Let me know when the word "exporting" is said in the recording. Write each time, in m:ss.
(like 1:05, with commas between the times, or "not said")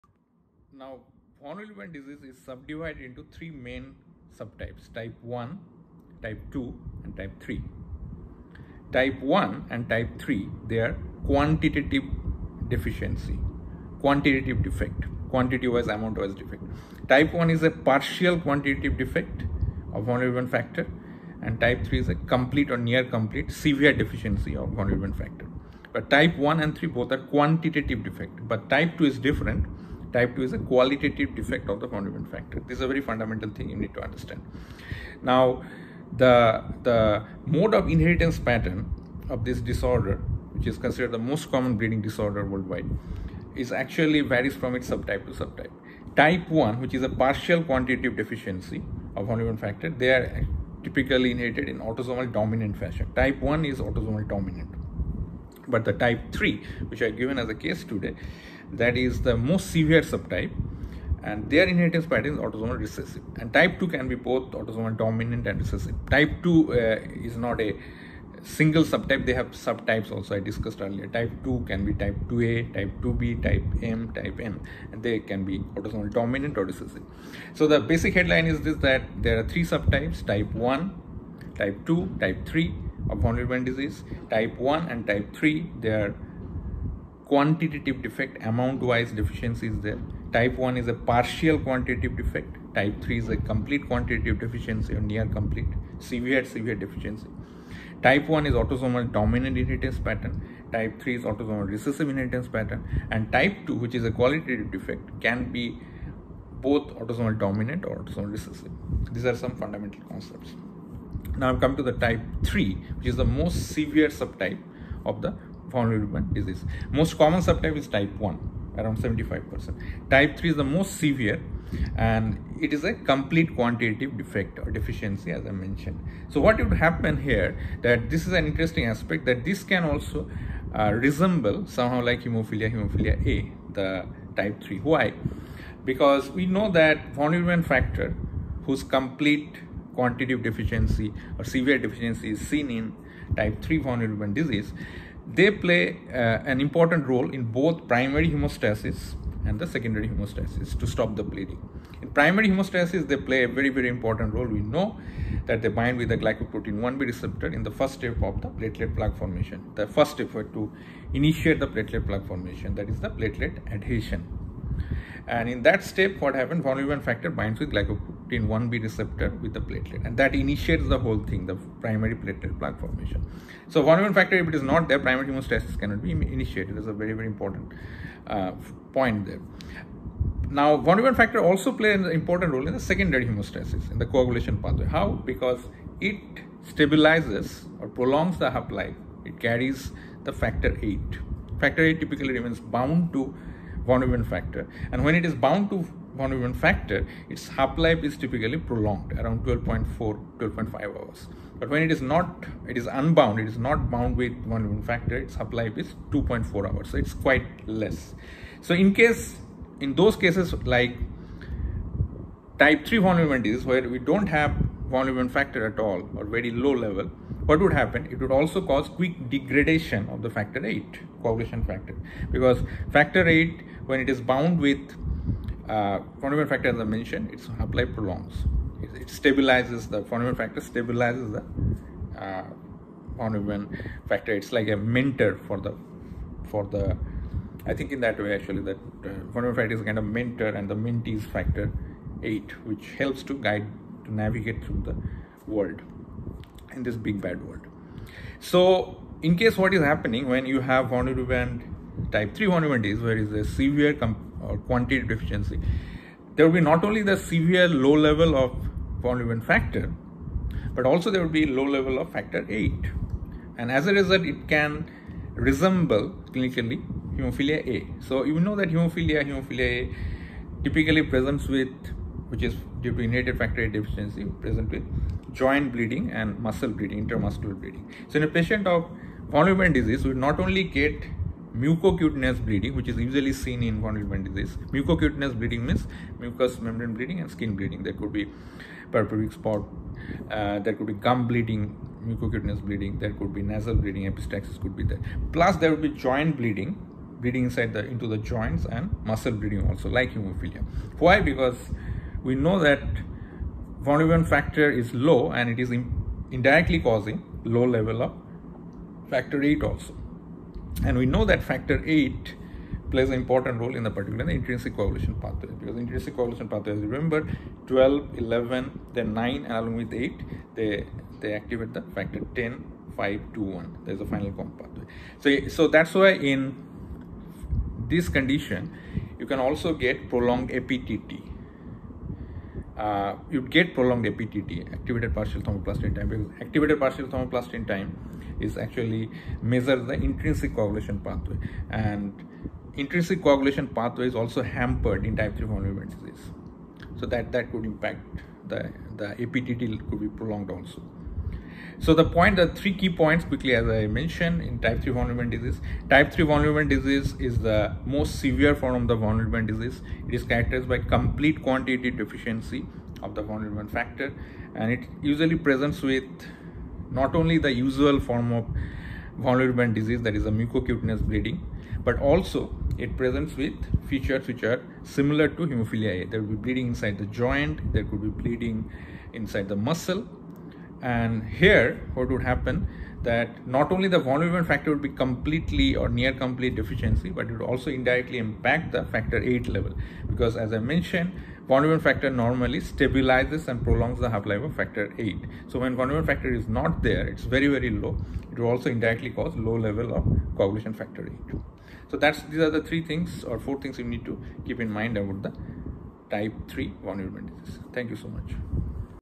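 not said.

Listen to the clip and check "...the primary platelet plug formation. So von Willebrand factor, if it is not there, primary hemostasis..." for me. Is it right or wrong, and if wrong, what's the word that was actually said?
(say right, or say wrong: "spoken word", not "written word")
right.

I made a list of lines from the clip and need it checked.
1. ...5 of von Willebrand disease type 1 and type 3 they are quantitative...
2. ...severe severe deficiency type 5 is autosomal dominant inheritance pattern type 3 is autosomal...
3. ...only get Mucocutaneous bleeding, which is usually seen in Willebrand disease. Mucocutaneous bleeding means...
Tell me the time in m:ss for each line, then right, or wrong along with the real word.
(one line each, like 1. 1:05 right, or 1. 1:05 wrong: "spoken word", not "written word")
1. 1:22 wrong: "3", not "5"
2. 1:36 wrong: "1", not "5"
3. 4:40 right.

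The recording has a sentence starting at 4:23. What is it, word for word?
And as a result, it can resemble clinically hemophilia A.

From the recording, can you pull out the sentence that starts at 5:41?
And intrinsic coagulation pathway is also hampered in type 3 familial disease.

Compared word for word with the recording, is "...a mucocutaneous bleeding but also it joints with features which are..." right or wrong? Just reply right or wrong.
wrong.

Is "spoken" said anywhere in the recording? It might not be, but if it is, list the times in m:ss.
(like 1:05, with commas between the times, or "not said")
not said.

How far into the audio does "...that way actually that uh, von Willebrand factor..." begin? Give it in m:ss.
3:58.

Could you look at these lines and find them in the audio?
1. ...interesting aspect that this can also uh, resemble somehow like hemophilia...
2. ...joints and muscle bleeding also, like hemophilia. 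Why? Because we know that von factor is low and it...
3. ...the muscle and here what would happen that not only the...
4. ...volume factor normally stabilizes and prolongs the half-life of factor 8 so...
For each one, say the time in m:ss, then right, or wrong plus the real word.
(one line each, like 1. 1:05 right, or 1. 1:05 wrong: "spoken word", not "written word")
1. 2:08 right
2. 4:58 right
3. 6:19 right
4. 6:31 right.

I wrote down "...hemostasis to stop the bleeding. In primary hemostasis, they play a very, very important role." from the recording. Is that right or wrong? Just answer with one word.
right.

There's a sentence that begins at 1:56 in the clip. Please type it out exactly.
Most common subtype is type 1, around 75%.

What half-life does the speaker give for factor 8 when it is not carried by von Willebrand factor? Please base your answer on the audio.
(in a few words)
2.4 hours.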